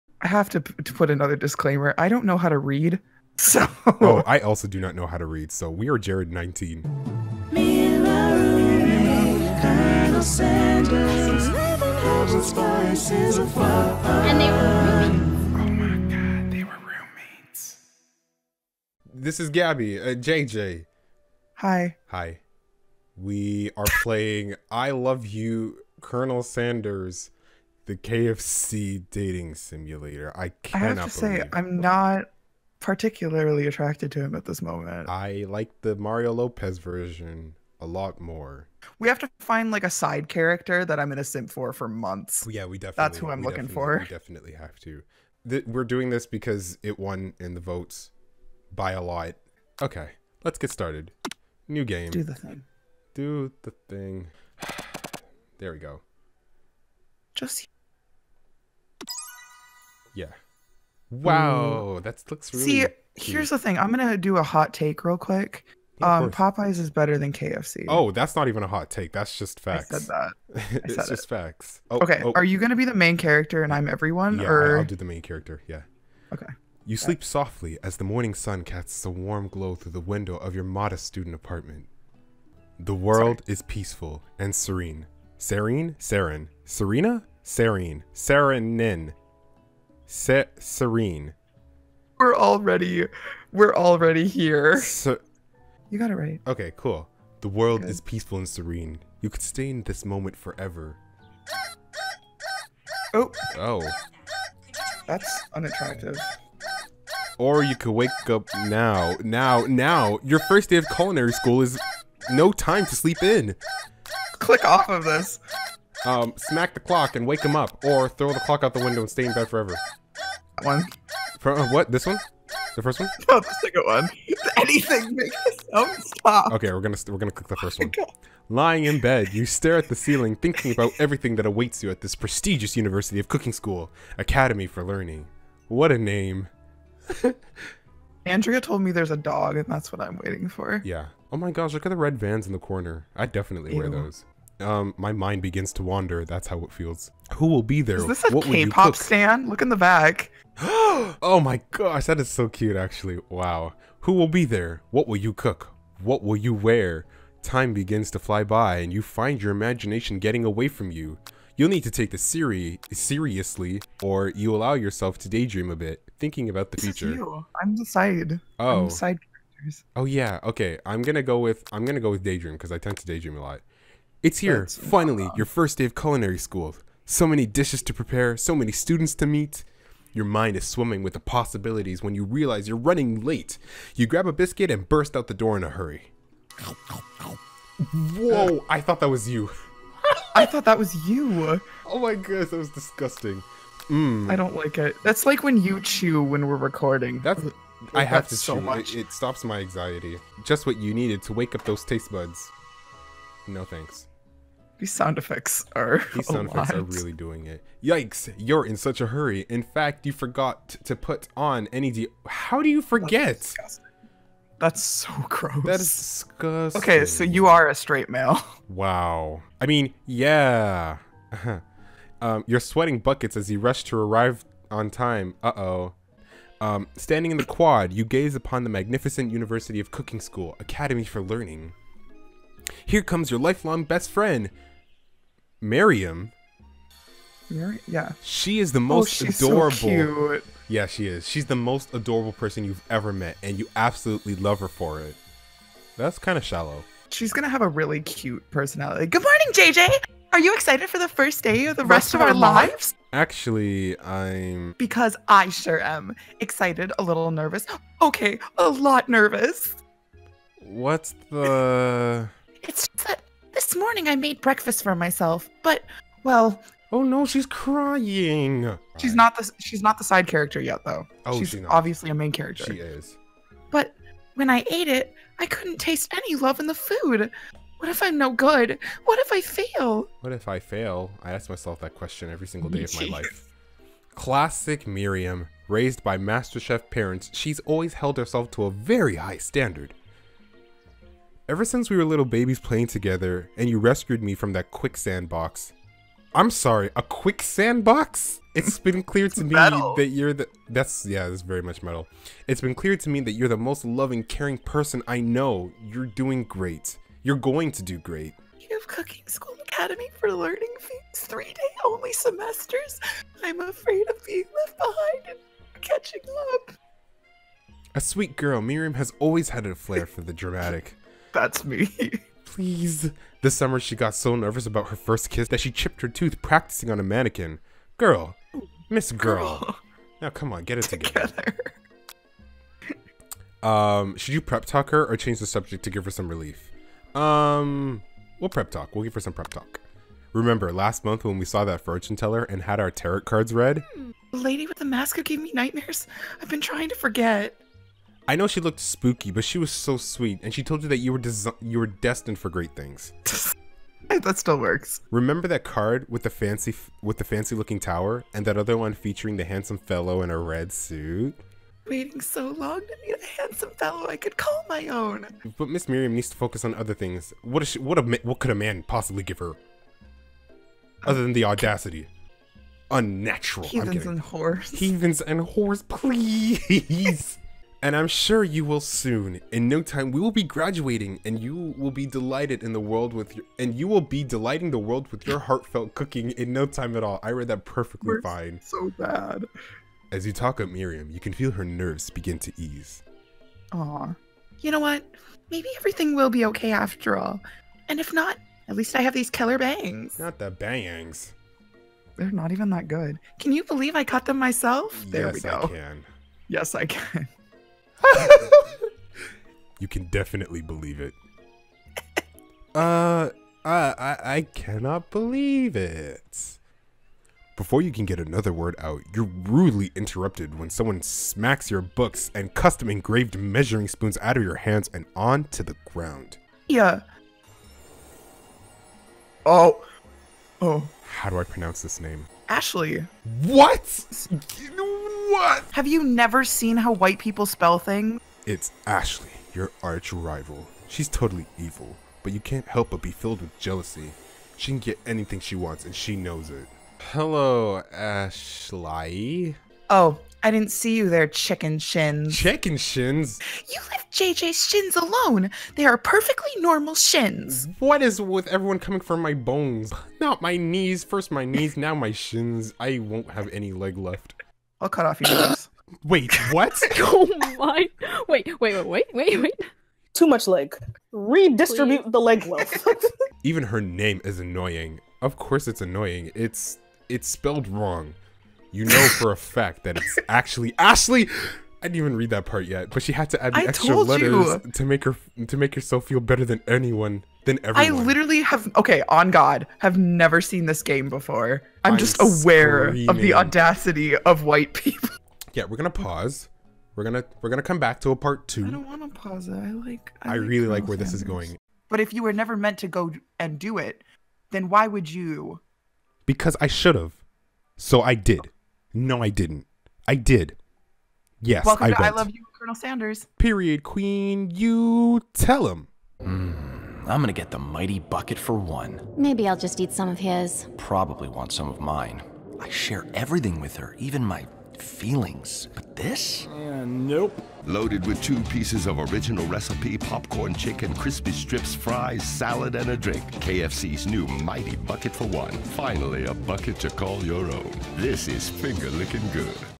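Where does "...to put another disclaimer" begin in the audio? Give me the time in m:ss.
0:00.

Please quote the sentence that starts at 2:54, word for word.
It's here, That's finally, your first day of culinary school.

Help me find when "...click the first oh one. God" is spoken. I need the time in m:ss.
2:07.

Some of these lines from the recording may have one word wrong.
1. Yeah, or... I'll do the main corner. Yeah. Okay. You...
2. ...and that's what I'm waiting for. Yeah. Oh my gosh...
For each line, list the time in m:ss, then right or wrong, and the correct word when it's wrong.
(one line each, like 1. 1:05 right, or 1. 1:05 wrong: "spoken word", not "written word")
1. 1:14 wrong: "character", not "corner"
2. 2:19 right.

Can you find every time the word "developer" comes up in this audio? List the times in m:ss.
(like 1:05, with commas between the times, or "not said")
not said.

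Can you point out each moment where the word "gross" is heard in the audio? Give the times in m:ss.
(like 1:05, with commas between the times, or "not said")
3:35.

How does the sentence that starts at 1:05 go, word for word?
Yeah, um, Popeyes is better than KFC.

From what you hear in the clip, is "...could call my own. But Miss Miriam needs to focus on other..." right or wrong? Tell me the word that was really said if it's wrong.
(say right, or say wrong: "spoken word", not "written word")
right.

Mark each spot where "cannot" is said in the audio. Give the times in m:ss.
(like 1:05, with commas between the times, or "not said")
0:30, 6:54.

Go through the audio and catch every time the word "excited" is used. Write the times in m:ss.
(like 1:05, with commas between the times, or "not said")
4:10, 4:16.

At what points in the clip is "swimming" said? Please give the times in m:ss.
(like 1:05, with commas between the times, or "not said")
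3:00.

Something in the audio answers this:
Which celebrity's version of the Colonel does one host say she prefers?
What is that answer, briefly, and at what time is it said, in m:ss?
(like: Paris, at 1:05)
Mario Lopez, at 0:35.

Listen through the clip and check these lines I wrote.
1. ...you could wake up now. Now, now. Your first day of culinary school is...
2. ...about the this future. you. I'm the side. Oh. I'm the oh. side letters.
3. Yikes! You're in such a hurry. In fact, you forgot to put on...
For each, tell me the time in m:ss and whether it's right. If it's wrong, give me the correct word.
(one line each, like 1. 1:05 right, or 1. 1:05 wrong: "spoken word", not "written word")
1. 1:47 right
2. 2:46 wrong: "characters", not "letters"
3. 3:27 right.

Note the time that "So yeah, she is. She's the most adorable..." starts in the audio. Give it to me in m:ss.
4:00.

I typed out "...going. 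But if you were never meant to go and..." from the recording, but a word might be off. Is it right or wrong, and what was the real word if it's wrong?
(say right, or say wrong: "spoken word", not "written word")
right.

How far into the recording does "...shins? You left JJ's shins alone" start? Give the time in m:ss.
7:32.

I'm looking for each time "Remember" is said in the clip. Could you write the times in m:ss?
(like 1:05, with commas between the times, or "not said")
5:40, 5:55.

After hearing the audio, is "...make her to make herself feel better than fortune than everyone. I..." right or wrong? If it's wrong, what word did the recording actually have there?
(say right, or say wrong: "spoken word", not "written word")
wrong: "anyone", not "fortune".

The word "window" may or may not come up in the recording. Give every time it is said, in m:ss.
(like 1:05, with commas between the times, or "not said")
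1:19, 1:58.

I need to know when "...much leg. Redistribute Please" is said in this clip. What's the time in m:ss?
7:50.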